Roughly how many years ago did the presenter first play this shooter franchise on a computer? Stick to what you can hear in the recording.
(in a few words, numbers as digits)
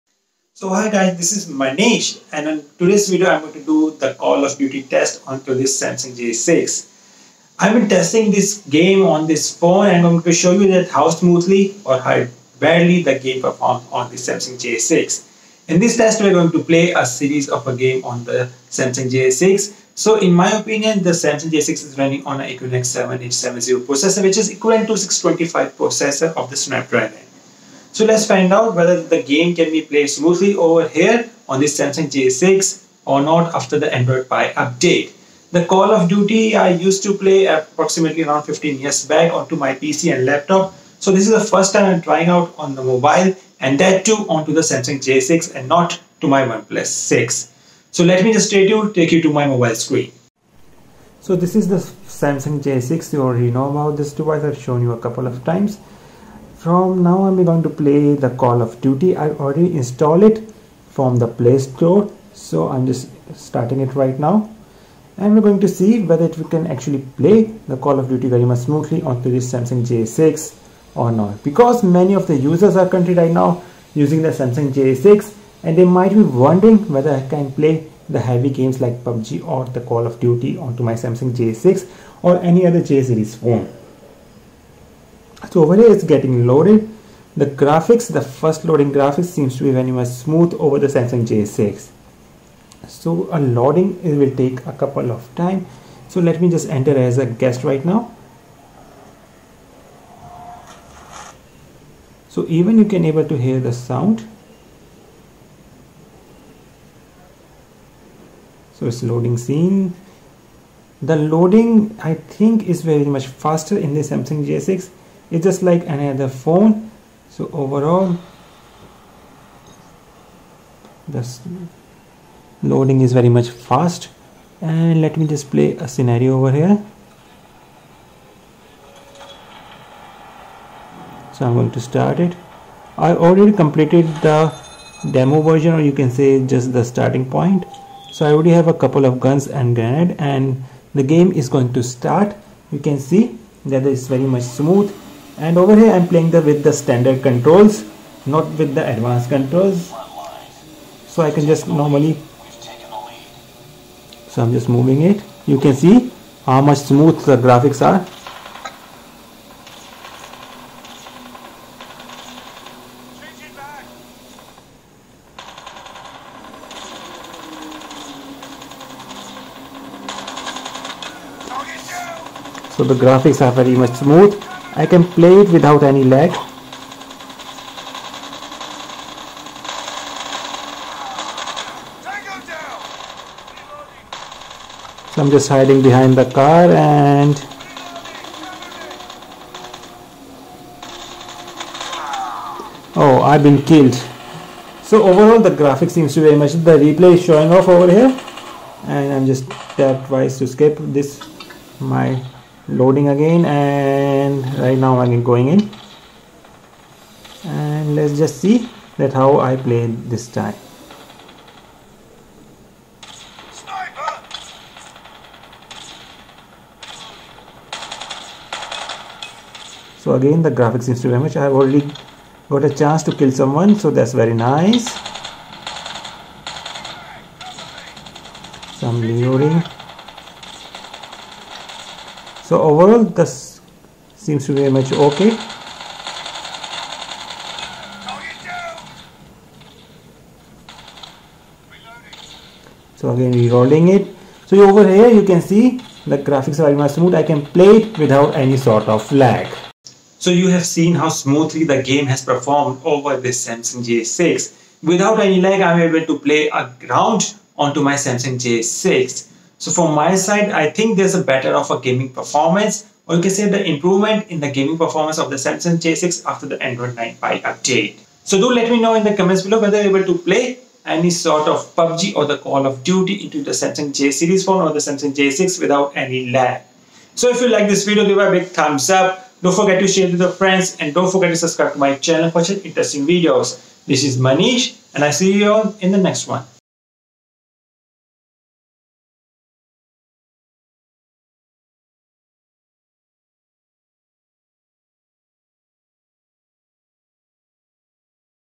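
15 years.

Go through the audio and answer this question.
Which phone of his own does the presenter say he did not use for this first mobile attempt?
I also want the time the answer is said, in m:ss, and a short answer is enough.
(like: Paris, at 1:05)
OnePlus 6, at 0:46.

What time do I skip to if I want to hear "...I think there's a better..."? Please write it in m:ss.
4:20.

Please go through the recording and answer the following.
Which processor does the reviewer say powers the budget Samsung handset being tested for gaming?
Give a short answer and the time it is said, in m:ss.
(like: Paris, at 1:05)
Exynos 7870, at 0:22.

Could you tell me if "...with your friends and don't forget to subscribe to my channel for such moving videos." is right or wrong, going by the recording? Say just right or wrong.
wrong.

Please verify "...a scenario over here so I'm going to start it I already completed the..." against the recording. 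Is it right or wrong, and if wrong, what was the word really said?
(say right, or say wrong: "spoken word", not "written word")
right.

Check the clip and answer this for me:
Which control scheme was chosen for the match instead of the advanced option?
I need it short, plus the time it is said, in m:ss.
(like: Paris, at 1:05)
standard controls, at 2:26.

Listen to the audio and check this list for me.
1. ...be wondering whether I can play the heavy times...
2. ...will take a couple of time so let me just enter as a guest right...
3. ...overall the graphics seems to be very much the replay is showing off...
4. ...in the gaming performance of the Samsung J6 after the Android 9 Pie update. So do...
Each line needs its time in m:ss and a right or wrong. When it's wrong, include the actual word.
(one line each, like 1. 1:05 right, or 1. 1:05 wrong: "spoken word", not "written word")
1. 1:16 wrong: "games", not "times"
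2. 1:34 right
3. 3:15 right
4. 4:24 right.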